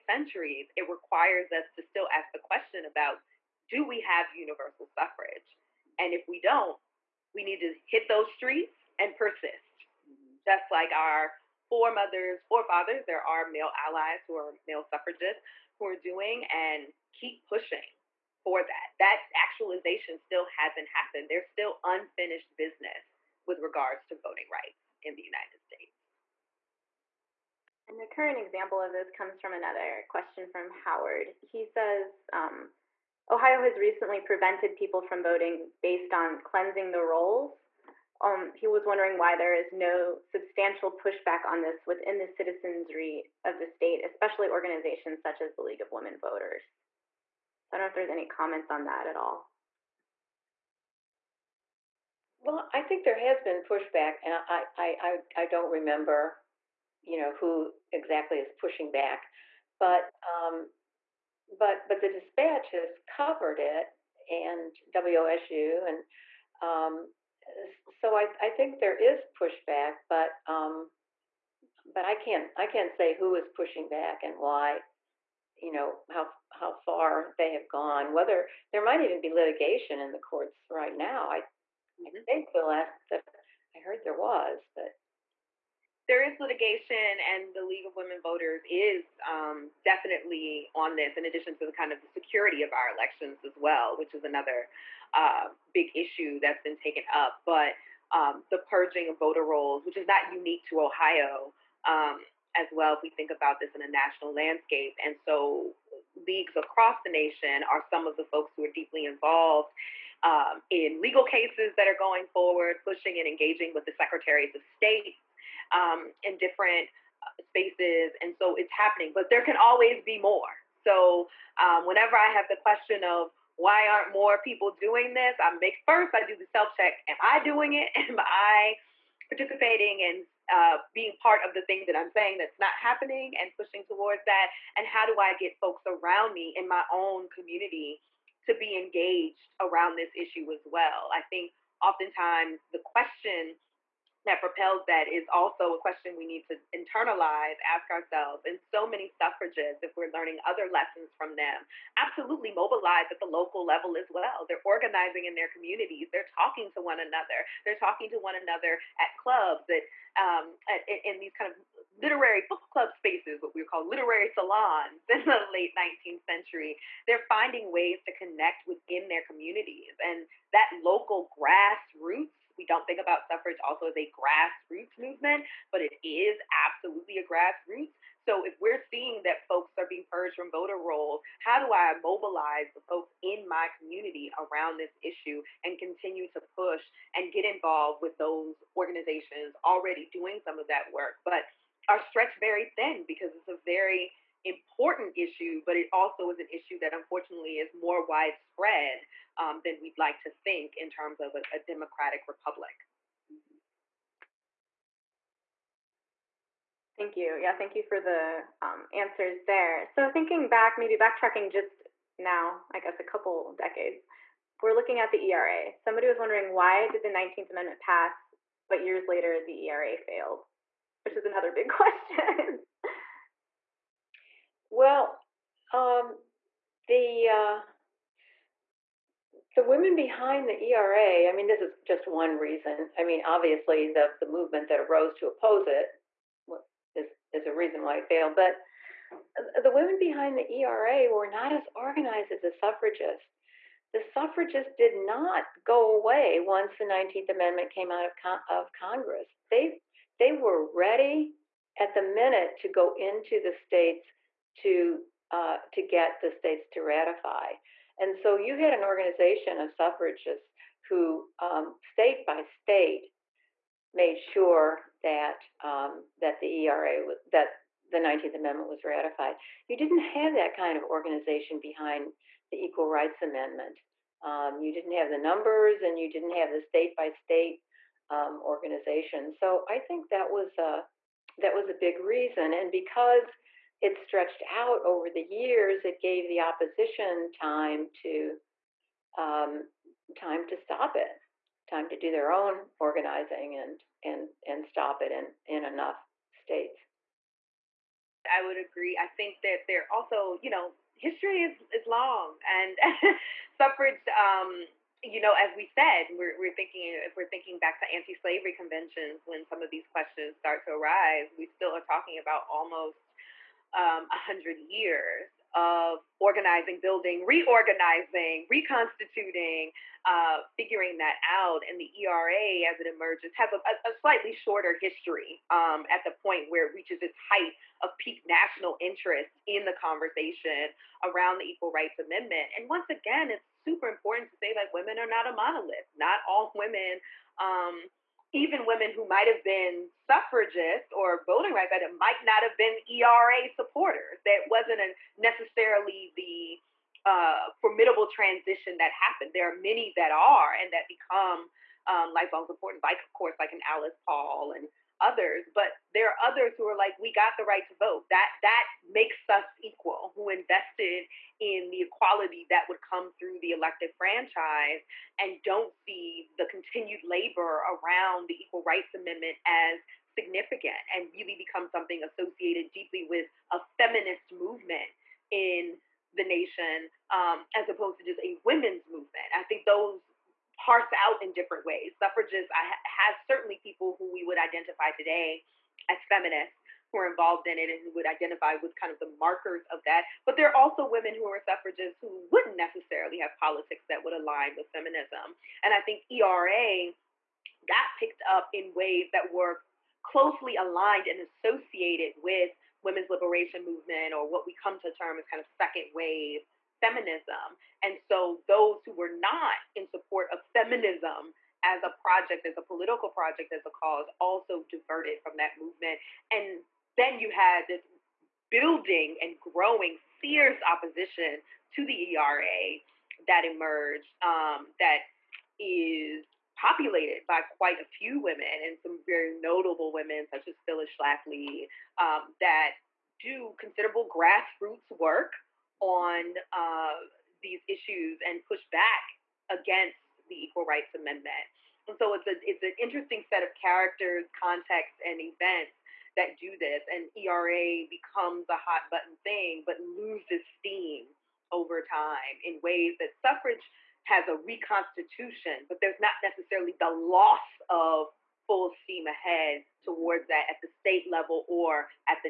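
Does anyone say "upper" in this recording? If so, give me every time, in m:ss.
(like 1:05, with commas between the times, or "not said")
not said.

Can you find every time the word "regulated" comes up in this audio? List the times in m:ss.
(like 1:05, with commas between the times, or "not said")
not said.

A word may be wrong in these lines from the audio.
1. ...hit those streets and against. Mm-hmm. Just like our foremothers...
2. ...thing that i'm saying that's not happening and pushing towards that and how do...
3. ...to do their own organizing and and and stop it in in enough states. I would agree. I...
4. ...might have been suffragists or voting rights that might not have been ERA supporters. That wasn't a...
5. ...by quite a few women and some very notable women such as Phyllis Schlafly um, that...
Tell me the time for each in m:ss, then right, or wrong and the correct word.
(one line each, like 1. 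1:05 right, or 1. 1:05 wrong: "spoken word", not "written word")
1. 0:07 wrong: "persist", not "against"
2. 2:11 right
3. 4:51 right
4. 5:39 right
5. 7:07 right.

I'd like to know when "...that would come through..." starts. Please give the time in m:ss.
6:02.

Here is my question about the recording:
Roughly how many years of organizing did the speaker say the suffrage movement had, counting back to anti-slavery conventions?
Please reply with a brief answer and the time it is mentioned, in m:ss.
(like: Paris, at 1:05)
100, at 5:14.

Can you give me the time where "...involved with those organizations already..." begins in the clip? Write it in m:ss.
3:07.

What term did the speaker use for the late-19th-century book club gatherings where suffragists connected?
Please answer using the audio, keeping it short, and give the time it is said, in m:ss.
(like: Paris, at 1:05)
literary salons, at 2:43.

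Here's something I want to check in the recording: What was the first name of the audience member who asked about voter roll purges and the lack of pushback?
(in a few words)
Howard.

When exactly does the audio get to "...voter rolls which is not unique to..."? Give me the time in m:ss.
1:39.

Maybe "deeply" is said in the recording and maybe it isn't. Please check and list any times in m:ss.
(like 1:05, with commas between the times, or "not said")
1:48, 6:12.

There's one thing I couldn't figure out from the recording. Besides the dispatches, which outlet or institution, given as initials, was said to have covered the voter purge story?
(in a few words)
WSU.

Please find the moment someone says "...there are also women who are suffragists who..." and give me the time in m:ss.
6:30.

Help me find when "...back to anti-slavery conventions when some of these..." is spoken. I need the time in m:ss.
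5:07.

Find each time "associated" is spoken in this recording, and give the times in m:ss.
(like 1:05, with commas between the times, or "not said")
6:12, 6:41.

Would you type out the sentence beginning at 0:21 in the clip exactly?
There's still unfinished business with regards to voting rights in the United States.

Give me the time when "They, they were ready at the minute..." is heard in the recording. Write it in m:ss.
4:09.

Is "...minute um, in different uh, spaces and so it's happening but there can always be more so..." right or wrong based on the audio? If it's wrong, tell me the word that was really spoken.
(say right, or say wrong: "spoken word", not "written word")
wrong: "state", not "minute".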